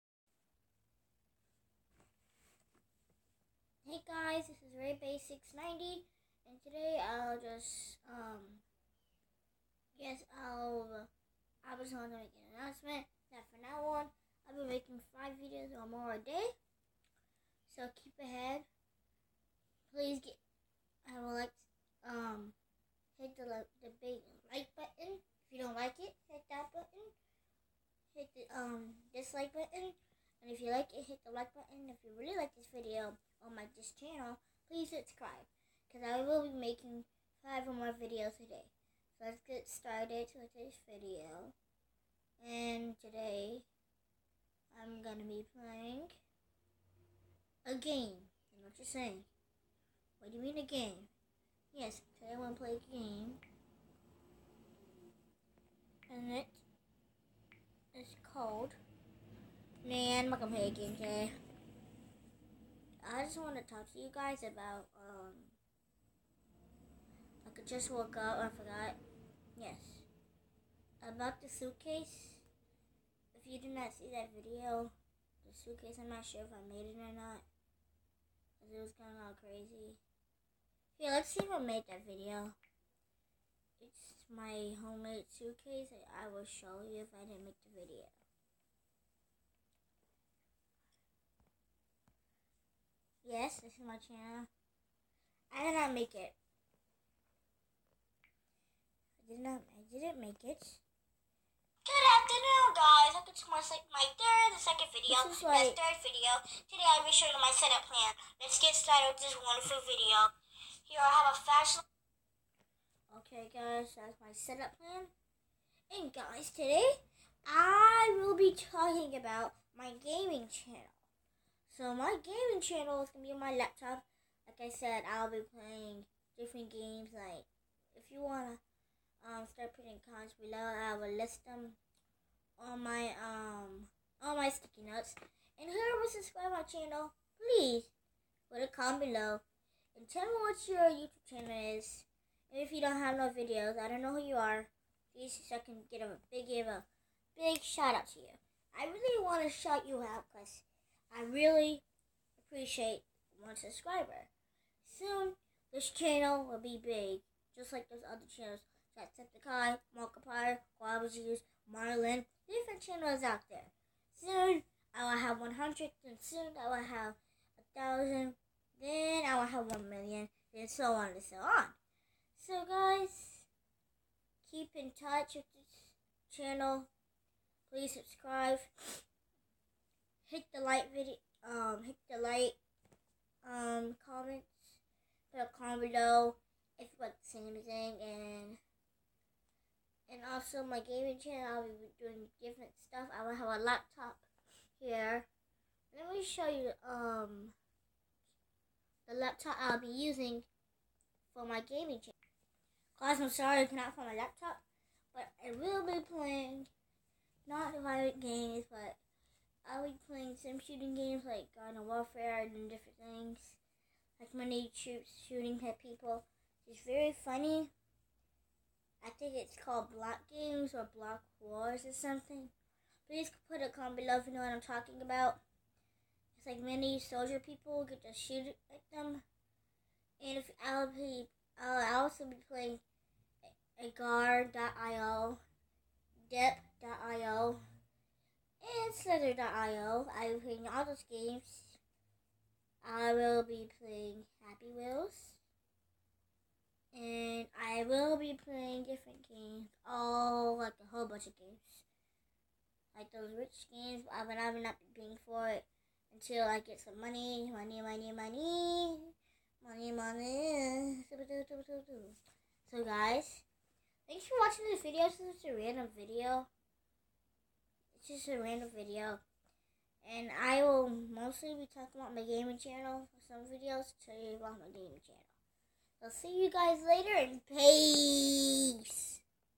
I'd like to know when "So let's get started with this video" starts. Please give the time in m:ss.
0:39.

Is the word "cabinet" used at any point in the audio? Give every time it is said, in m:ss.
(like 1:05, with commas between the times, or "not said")
not said.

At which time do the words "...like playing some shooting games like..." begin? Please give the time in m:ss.
3:29.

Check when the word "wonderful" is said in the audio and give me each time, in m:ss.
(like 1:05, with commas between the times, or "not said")
1:49.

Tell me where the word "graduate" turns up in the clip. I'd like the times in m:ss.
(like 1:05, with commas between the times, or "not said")
not said.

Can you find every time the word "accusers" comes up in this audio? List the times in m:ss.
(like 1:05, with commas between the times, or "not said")
not said.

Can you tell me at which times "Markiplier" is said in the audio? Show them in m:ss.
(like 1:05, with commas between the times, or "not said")
2:39.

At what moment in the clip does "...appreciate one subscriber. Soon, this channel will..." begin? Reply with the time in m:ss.
2:32.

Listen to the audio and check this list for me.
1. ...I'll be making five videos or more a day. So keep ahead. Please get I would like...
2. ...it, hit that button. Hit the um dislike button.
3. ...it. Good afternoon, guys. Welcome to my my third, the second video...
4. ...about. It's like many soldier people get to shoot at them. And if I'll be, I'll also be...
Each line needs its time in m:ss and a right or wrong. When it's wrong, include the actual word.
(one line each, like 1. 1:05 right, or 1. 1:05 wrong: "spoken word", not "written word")
1. 0:14 right
2. 0:25 right
3. 1:40 right
4. 3:45 right.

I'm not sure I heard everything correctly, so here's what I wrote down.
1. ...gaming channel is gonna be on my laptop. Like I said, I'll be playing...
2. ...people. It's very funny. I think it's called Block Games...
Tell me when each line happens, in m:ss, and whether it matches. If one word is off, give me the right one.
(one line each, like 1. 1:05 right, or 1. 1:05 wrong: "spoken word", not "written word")
1. 2:02 right
2. 3:35 right.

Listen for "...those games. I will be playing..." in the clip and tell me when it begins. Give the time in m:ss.
4:00.